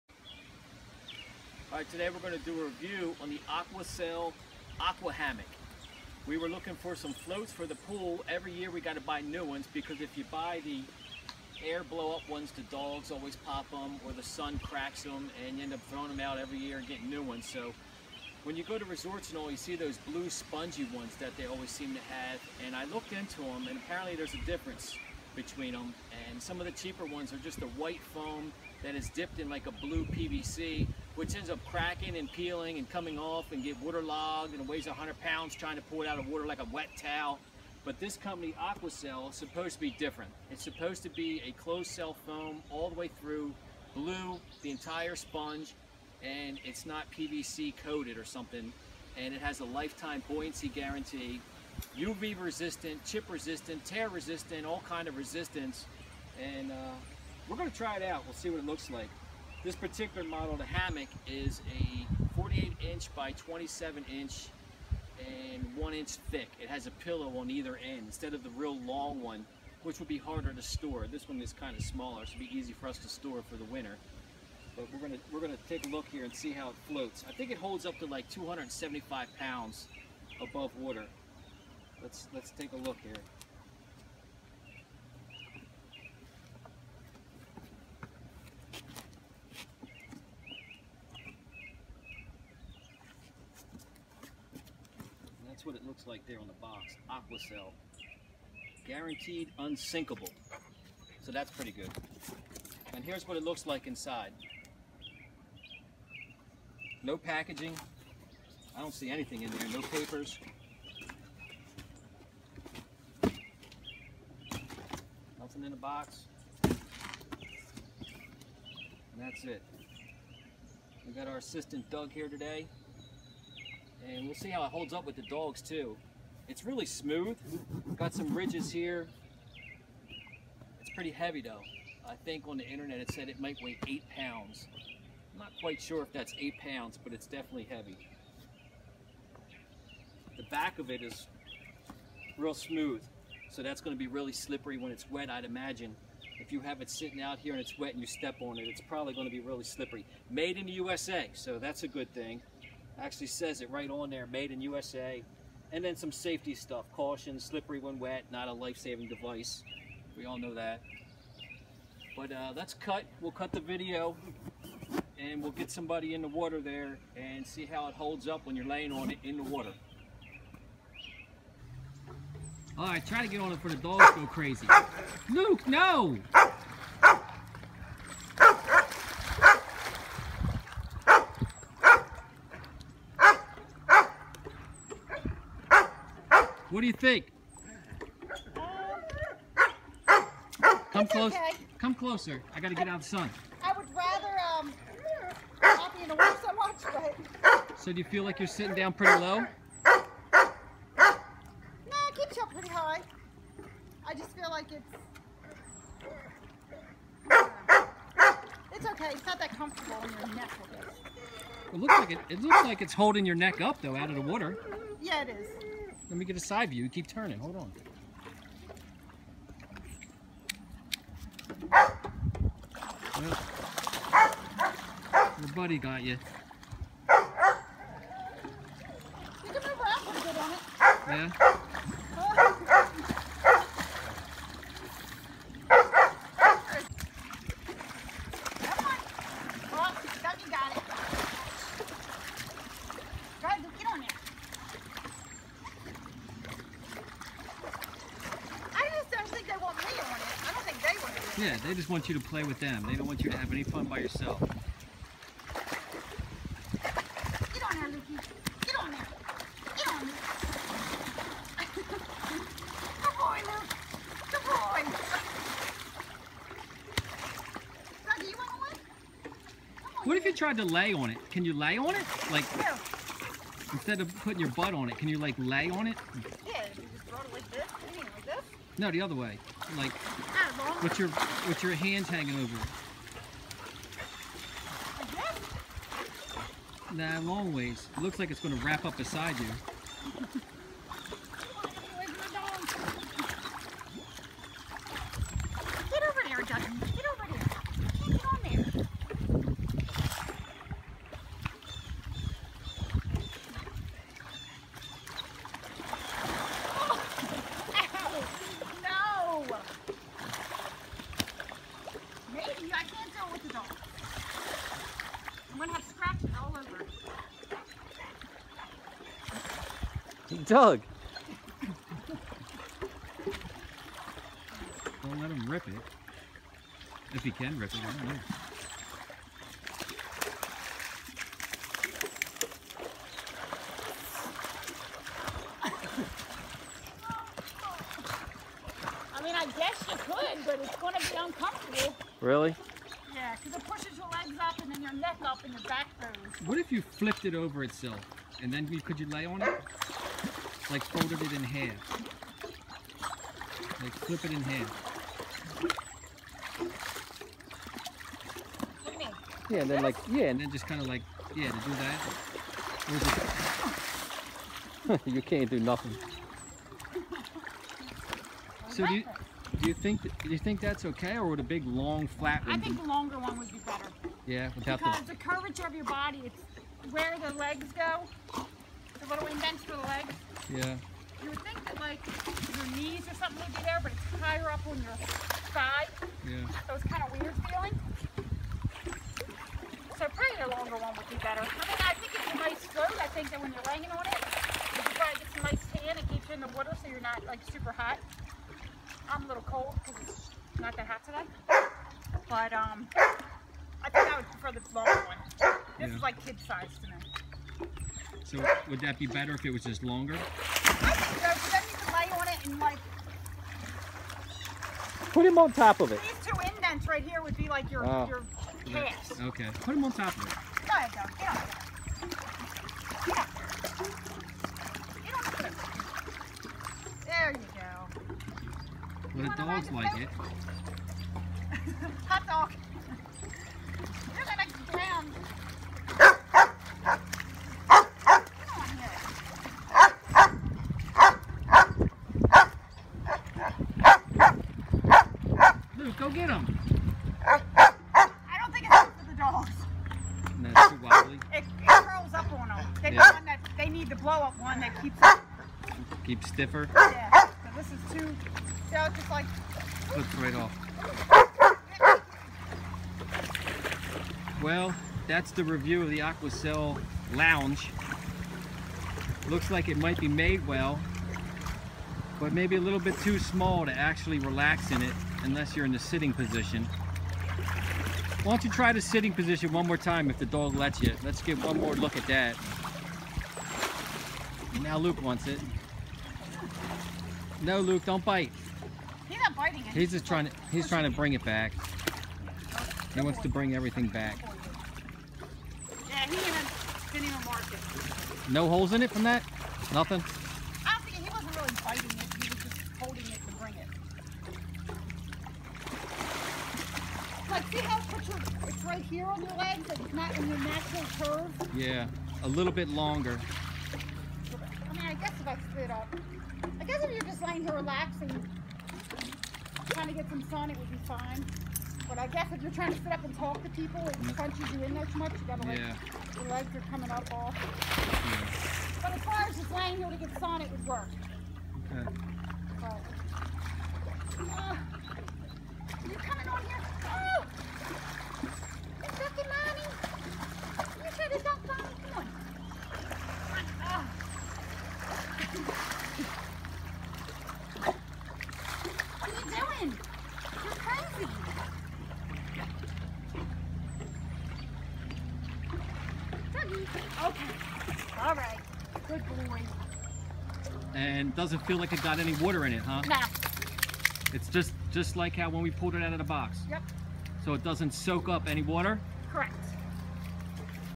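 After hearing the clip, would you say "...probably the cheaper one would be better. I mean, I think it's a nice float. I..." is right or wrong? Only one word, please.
wrong.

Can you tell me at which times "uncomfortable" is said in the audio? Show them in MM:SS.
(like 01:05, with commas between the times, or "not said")
05:41.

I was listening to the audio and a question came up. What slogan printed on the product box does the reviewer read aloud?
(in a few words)
Guaranteed unsinkable.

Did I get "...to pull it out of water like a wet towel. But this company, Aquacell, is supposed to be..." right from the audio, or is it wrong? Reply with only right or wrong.
right.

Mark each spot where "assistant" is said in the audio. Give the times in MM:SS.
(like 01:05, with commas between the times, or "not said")
02:01.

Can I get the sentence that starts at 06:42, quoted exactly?
But um, I think I would prefer the long one.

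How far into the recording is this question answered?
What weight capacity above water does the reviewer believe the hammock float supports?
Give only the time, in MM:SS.
01:18.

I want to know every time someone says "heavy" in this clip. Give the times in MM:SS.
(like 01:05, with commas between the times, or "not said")
02:11, 02:17.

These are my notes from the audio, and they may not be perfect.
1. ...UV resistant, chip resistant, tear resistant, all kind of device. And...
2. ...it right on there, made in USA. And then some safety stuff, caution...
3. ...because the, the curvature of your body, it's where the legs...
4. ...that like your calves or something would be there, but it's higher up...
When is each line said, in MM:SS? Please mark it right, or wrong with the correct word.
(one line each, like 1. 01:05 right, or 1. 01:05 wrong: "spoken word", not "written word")
1. 00:51 wrong: "resistance", not "device"
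2. 02:33 right
3. 06:14 right
4. 06:21 wrong: "knees", not "calves".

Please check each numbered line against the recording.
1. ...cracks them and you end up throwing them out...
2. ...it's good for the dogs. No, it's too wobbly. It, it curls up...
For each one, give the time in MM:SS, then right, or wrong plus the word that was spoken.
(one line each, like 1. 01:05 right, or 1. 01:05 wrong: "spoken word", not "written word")
1. 00:14 right
2. 07:28 right.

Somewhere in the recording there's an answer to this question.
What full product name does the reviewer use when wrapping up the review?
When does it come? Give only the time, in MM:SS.
07:45.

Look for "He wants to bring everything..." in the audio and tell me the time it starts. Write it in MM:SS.
08:12.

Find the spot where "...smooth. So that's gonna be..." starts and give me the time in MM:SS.
02:22.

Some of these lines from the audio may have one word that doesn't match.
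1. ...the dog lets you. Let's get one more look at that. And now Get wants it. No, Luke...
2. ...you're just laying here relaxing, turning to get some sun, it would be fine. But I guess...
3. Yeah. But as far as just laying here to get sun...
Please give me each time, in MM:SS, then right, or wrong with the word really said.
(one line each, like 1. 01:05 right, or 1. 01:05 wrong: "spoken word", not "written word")
1. 08:00 wrong: "Luke", not "Get"
2. 08:36 wrong: "trying", not "turning"
3. 08:48 right.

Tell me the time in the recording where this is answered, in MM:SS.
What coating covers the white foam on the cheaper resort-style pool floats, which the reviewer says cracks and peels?
00:29.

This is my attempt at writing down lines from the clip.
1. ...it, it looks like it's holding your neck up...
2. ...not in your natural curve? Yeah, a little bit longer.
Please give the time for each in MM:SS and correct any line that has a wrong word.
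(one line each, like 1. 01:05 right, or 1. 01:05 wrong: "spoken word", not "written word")
1. 03:32 right
2. 08:29 right.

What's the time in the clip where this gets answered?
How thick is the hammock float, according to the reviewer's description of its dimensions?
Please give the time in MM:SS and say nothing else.
01:05.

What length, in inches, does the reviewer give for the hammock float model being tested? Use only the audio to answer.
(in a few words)
48 inches.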